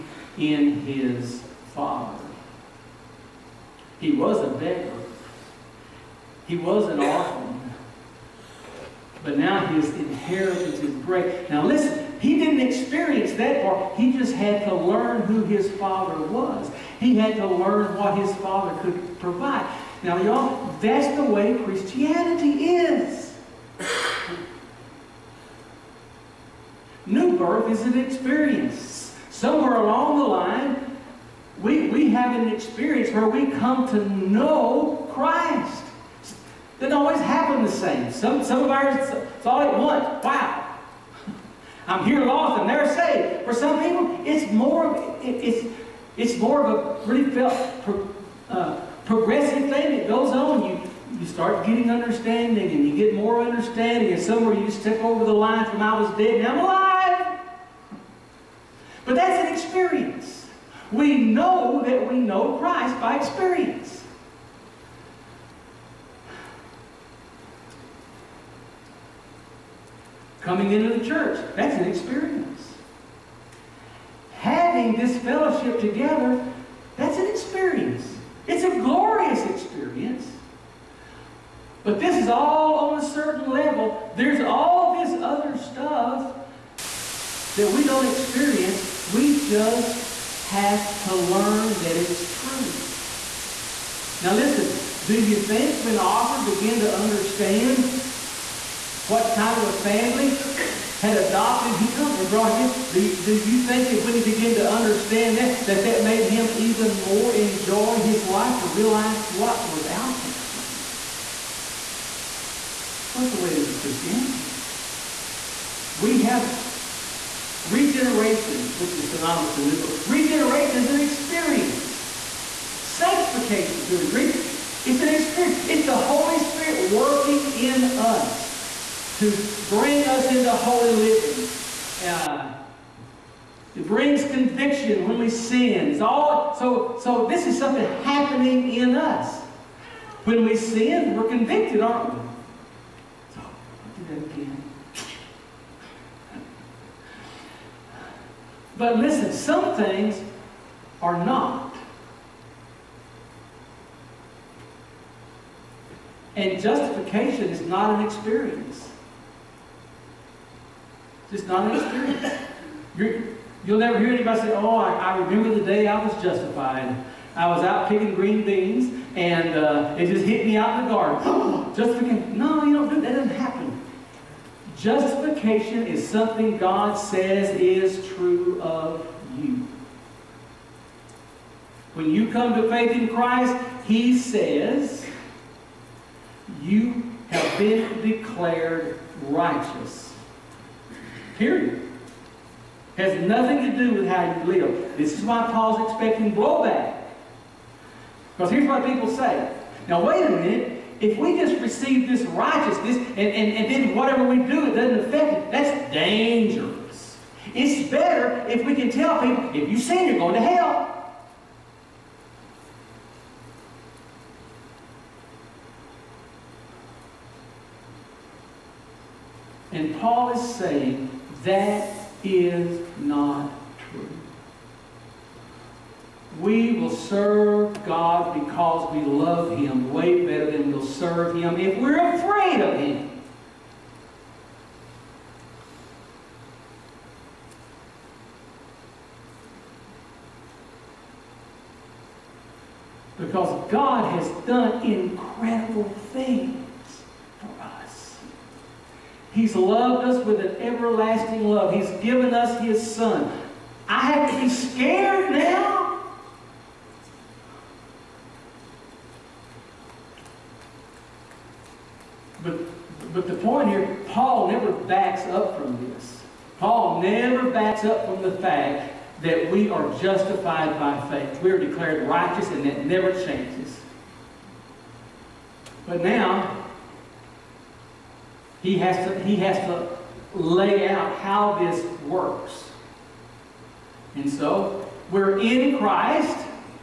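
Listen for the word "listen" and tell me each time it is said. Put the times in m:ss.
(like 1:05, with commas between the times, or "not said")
0:11, 1:34, 2:28.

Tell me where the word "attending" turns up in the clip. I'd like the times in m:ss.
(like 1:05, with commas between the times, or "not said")
not said.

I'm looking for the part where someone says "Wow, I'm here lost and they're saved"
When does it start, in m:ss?
0:40.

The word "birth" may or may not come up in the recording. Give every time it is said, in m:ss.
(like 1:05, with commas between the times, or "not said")
0:27, 1:59.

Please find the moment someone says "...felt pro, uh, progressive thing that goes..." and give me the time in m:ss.
0:47.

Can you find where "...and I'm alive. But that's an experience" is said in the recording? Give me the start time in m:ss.
0:56.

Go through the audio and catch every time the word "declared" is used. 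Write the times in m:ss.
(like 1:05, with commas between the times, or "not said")
3:08, 4:31.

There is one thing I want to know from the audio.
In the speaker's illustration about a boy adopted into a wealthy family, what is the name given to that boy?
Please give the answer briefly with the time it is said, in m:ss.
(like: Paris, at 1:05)
Arthur, at 1:35.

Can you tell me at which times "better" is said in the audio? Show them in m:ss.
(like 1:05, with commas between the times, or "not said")
3:27, 3:50.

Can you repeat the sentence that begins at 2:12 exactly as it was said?
Uh, it brings conviction when we sin.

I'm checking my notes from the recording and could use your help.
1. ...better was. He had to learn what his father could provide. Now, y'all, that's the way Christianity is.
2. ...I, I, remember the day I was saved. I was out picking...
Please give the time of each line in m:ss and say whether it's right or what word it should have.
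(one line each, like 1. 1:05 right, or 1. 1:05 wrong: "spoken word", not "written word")
1. 0:15 wrong: "father", not "better"
2. 2:44 wrong: "justified", not "saved".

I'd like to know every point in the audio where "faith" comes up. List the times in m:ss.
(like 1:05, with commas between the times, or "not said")
3:02, 4:31.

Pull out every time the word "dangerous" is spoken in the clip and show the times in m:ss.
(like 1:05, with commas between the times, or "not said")
3:25.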